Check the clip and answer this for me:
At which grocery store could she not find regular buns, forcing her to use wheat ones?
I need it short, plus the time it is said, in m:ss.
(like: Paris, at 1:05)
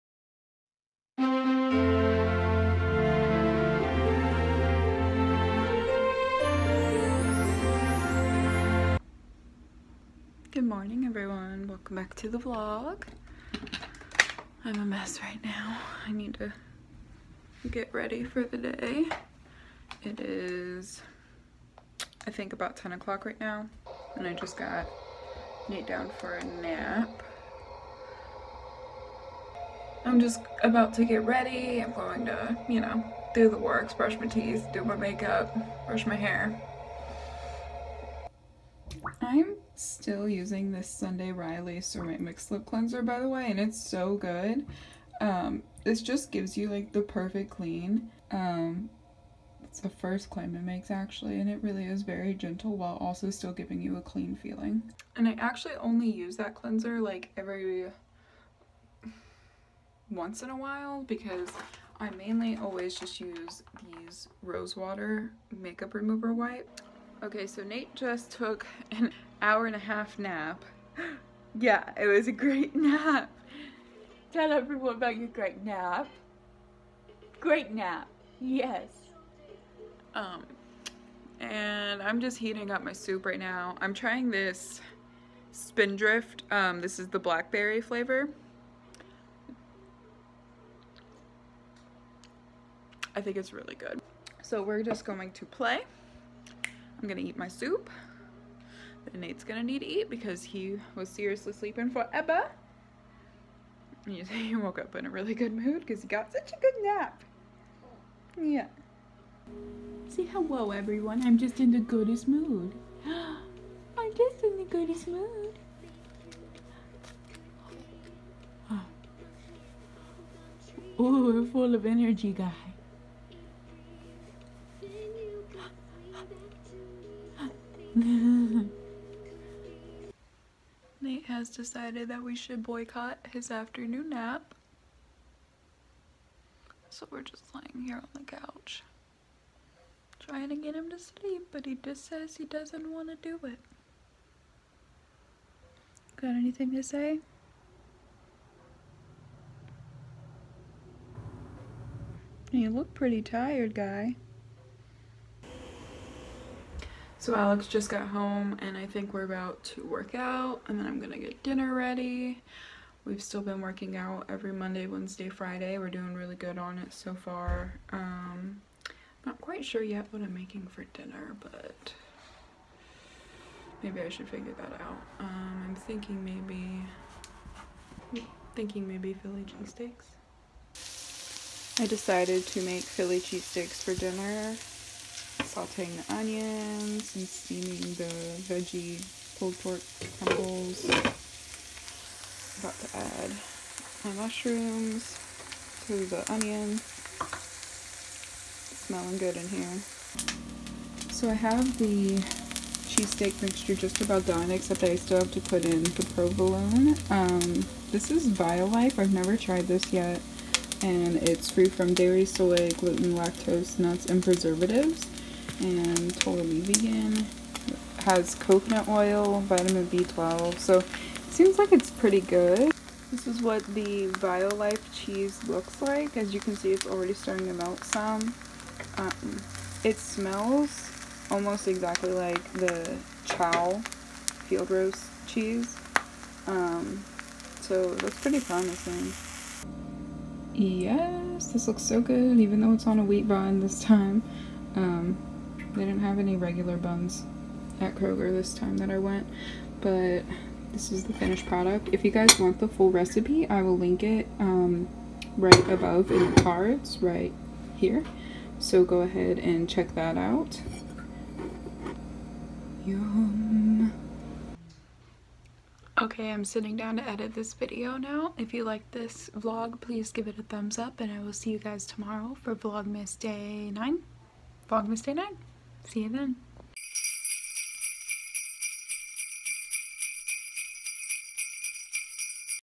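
Kroger, at 4:07.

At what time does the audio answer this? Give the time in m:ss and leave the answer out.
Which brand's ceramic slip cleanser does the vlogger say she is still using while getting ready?
0:40.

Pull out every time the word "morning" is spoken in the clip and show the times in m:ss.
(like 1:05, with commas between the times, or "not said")
0:10.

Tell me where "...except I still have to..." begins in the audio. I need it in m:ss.
3:24.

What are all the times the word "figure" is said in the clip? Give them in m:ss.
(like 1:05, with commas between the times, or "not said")
2:54.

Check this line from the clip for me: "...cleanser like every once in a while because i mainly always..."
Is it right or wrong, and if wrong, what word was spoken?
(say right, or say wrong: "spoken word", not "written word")
right.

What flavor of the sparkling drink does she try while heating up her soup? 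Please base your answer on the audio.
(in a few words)
Blackberry.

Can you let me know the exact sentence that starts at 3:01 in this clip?
I decided to make Philly cheesesteaks for dinner sauteing the onions and steaming the veggie pulled pork crumbles.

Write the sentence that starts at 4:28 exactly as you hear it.
If you like this vlog, please give it a thumbs up and I will see you guys tomorrow for Vlogmas Day 9.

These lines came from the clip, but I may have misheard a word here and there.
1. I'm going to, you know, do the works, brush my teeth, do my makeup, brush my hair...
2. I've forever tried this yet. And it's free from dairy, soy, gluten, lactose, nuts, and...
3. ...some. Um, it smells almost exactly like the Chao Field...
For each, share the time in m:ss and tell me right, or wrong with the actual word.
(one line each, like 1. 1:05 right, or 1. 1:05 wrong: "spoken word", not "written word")
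1. 0:31 right
2. 3:28 wrong: "never", not "forever"
3. 3:47 right.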